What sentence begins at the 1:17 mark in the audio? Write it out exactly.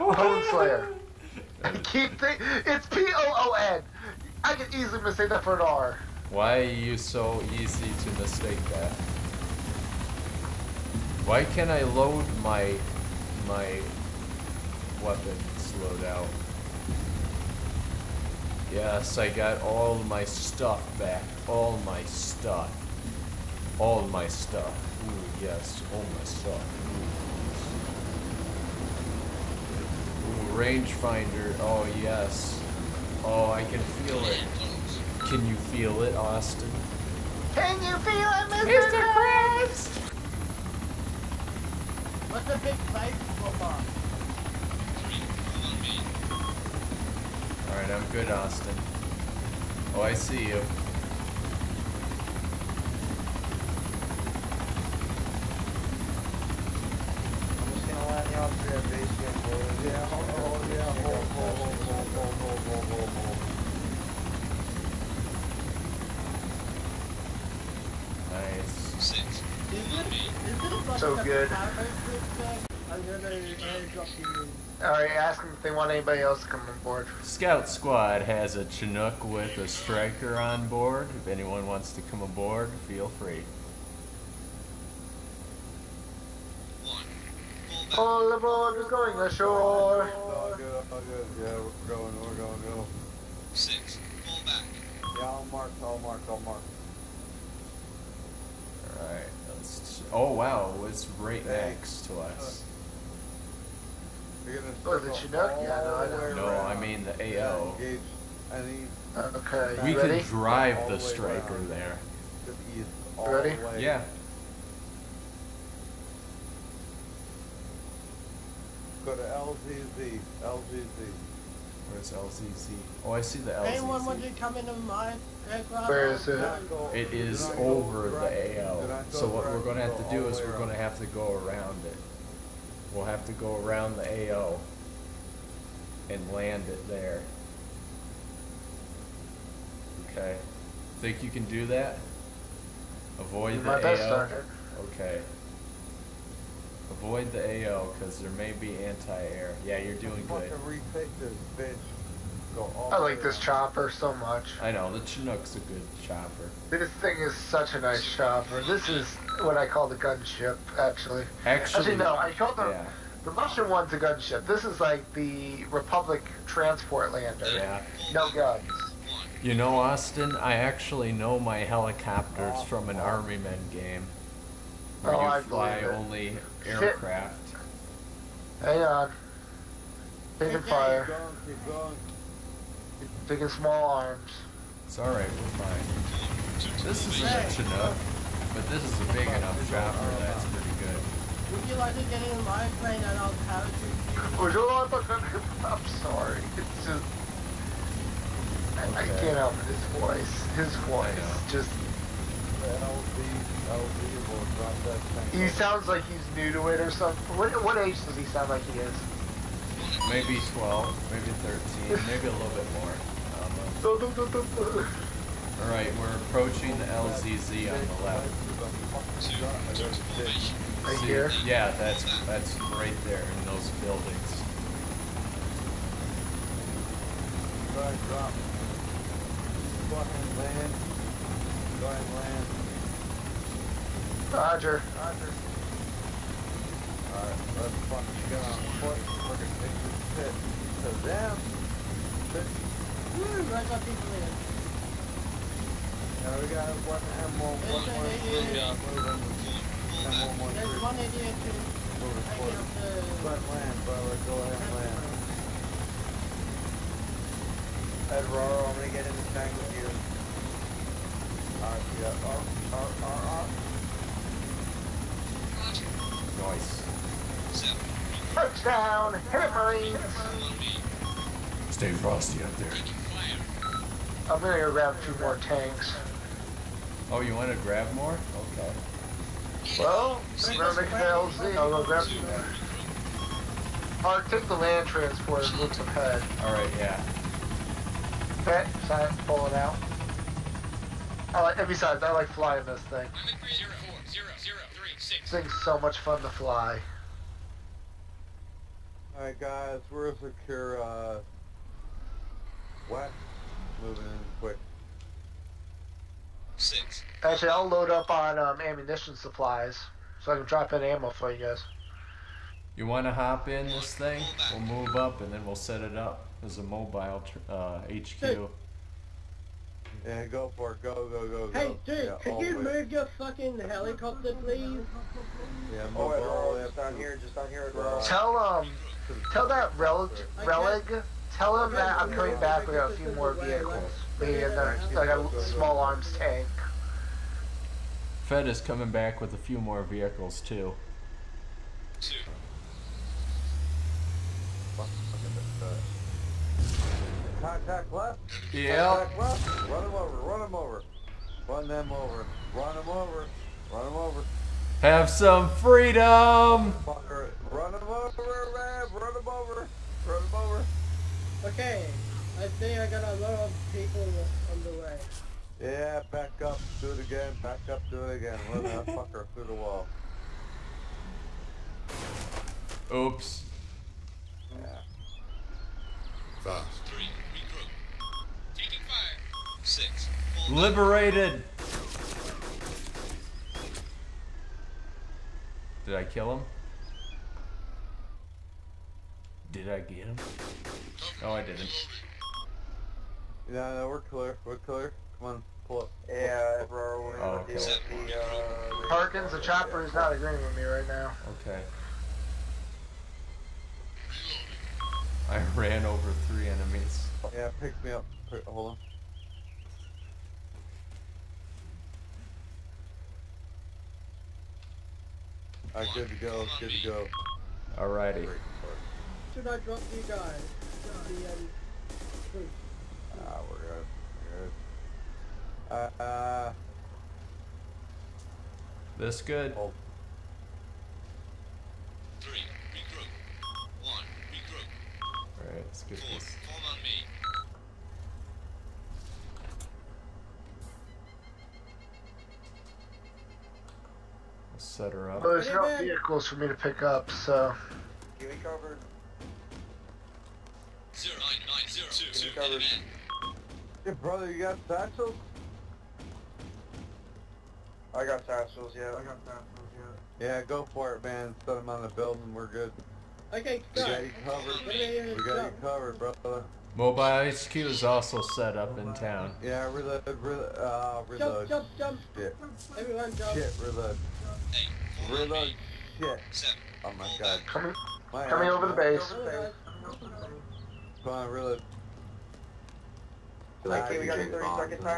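Scout Squad has a Chinook with a Stryker on board.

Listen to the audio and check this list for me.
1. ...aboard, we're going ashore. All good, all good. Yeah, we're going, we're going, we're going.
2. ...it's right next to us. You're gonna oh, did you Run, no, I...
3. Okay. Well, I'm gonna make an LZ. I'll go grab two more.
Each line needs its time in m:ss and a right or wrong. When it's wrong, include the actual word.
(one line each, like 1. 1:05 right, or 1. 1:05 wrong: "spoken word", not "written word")
1. 1:28 right
2. 1:40 wrong: "Yeah", not "Run"
3. 4:38 right.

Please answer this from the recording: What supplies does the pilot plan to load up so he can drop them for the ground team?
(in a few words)
ammunition.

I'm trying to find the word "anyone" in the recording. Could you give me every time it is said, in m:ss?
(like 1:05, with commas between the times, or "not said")
1:21, 2:03.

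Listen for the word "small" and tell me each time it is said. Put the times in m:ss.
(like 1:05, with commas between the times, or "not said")
3:03, 5:35.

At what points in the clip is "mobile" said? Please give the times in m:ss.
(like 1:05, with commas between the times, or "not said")
5:16, 7:46.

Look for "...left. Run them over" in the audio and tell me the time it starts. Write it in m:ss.
5:49.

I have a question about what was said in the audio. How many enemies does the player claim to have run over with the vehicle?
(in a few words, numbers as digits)
3.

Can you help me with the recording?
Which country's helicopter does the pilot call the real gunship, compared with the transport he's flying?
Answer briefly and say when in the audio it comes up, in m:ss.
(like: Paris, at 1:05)
Russian, at 2:43.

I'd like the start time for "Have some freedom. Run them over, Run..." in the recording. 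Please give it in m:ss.
5:54.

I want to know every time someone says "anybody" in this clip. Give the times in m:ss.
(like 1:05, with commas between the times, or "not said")
1:15.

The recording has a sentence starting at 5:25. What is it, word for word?
Yeah, move oh, it all Just down here, just down here.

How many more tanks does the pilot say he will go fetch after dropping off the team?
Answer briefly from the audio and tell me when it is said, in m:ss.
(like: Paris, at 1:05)
2, at 4:35.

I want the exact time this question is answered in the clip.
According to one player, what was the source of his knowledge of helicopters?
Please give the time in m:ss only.
2:52.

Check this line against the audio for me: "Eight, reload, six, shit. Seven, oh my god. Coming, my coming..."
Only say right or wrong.
wrong.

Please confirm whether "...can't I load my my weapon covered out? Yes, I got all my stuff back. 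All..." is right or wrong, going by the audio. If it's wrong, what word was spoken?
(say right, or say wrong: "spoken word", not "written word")
wrong: "slowed", not "covered".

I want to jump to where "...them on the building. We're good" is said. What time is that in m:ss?
7:41.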